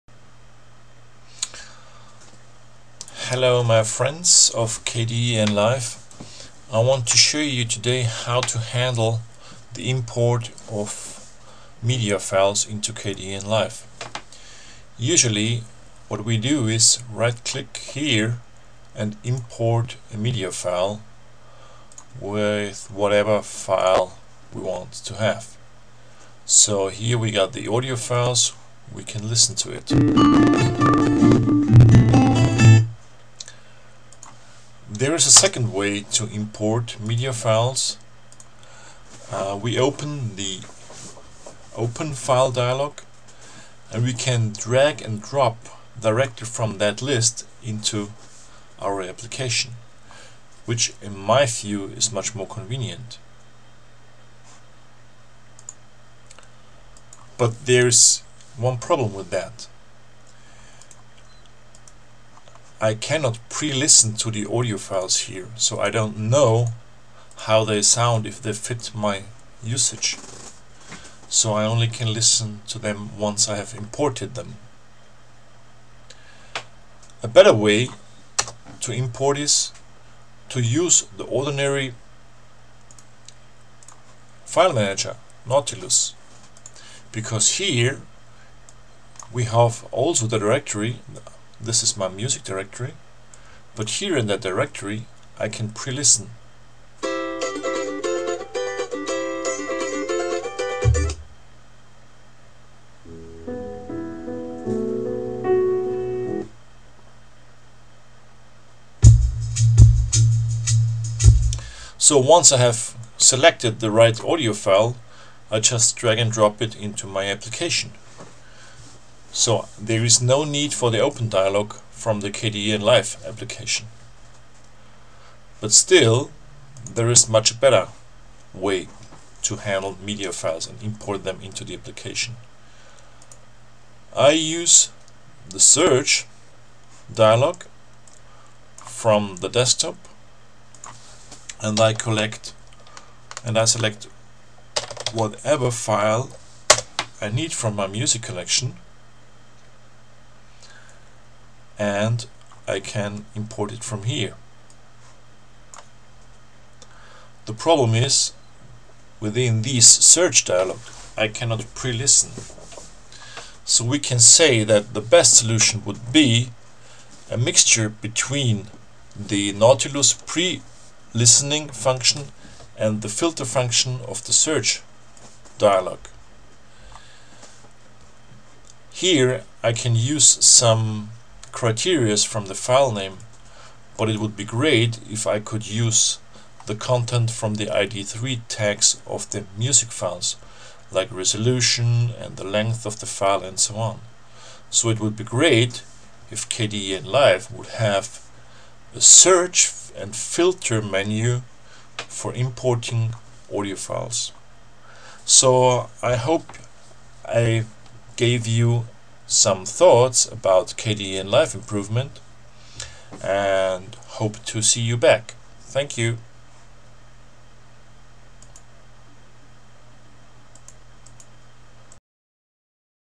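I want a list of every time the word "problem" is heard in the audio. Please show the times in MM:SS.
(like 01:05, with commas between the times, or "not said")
00:58, 02:37.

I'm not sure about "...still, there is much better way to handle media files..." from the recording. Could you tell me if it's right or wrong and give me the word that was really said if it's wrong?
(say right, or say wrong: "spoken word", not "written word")
right.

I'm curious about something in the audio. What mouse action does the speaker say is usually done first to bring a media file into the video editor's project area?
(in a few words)
Right click.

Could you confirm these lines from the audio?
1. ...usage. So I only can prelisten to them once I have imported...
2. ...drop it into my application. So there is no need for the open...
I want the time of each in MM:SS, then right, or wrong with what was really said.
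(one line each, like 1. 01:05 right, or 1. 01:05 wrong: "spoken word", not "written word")
1. 01:09 wrong: "listen", not "prelisten"
2. 01:56 right.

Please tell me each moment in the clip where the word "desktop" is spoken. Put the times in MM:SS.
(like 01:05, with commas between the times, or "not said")
02:19.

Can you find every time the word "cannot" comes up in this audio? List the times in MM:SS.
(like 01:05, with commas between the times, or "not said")
01:02, 02:41.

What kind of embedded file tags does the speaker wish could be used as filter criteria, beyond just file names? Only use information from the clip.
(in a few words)
ID3 tags.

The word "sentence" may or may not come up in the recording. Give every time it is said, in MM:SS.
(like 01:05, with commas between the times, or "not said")
not said.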